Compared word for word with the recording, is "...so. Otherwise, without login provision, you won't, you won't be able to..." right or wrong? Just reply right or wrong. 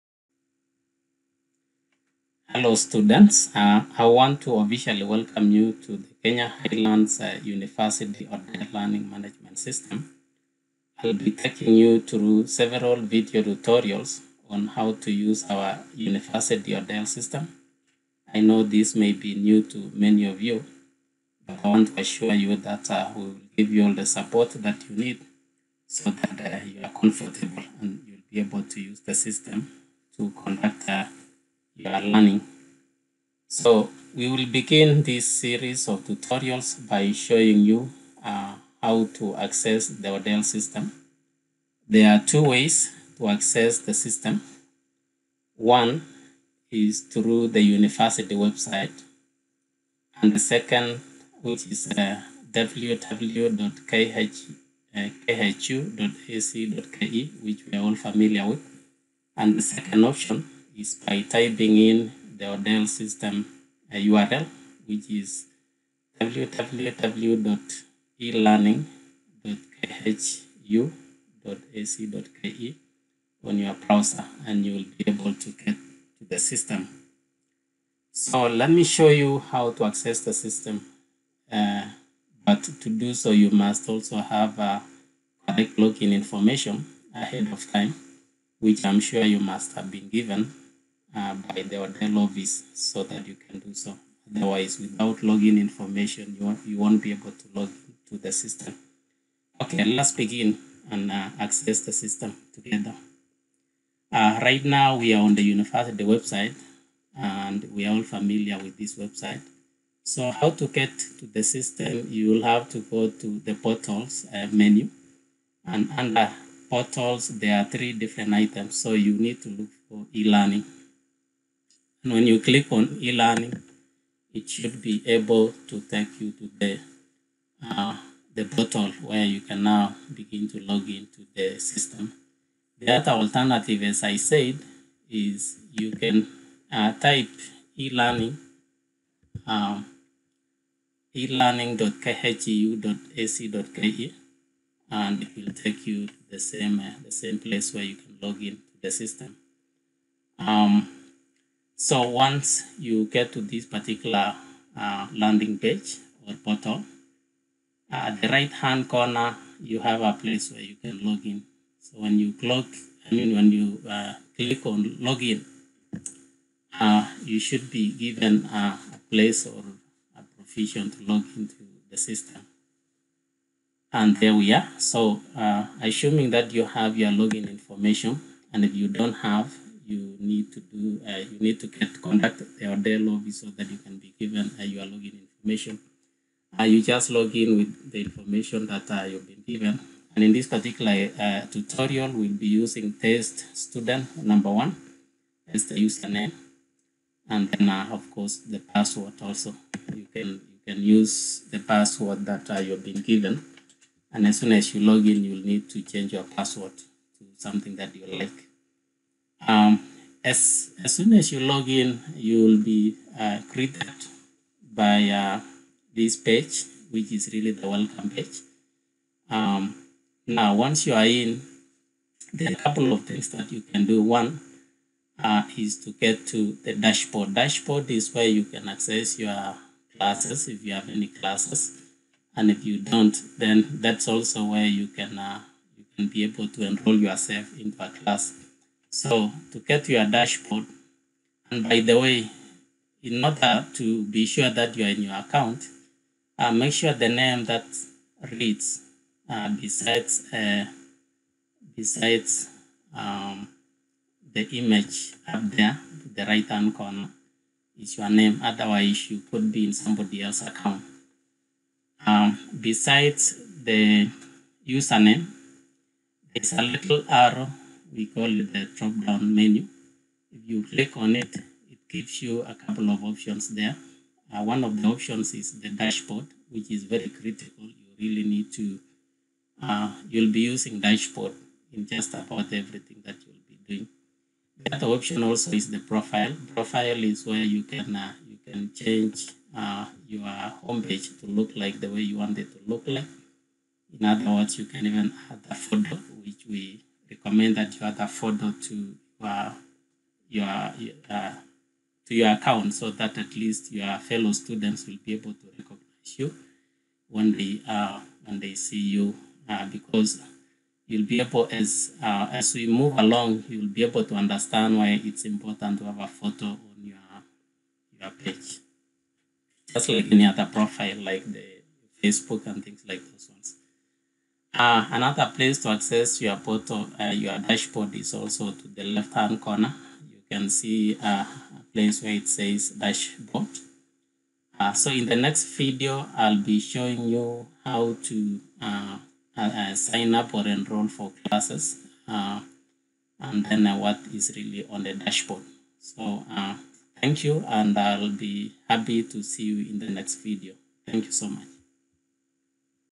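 wrong.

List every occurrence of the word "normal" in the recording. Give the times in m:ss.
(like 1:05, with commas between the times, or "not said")
not said.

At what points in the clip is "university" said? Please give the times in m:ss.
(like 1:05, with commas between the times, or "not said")
0:07, 0:15, 0:47, 1:45.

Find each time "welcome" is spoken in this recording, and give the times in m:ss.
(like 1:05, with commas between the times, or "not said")
0:05, 3:37.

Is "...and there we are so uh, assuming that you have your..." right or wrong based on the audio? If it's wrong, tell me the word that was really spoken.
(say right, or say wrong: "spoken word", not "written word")
right.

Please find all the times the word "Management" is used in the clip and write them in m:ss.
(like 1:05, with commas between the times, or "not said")
0:09.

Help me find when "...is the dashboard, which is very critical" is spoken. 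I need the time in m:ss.
4:35.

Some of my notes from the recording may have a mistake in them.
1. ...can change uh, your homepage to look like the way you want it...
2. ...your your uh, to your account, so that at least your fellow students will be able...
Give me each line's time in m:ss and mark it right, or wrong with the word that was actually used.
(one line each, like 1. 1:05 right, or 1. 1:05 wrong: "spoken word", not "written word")
1. 4:48 right
2. 4:59 right.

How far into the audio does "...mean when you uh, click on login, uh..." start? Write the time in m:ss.
2:43.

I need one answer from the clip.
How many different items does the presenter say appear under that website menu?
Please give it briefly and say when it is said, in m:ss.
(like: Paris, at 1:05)
3, at 1:57.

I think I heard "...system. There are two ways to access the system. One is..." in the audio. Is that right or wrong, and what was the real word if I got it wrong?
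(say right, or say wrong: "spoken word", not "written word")
right.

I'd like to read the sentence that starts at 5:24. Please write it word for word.
Uh, another place to access your portal, uh, your dashboard is also to the left-hand corner.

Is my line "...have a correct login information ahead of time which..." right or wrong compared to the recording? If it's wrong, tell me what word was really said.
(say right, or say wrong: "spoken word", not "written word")
right.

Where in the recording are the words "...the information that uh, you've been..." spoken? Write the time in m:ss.
3:07.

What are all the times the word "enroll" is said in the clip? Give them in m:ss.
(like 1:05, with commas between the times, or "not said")
3:56, 5:40.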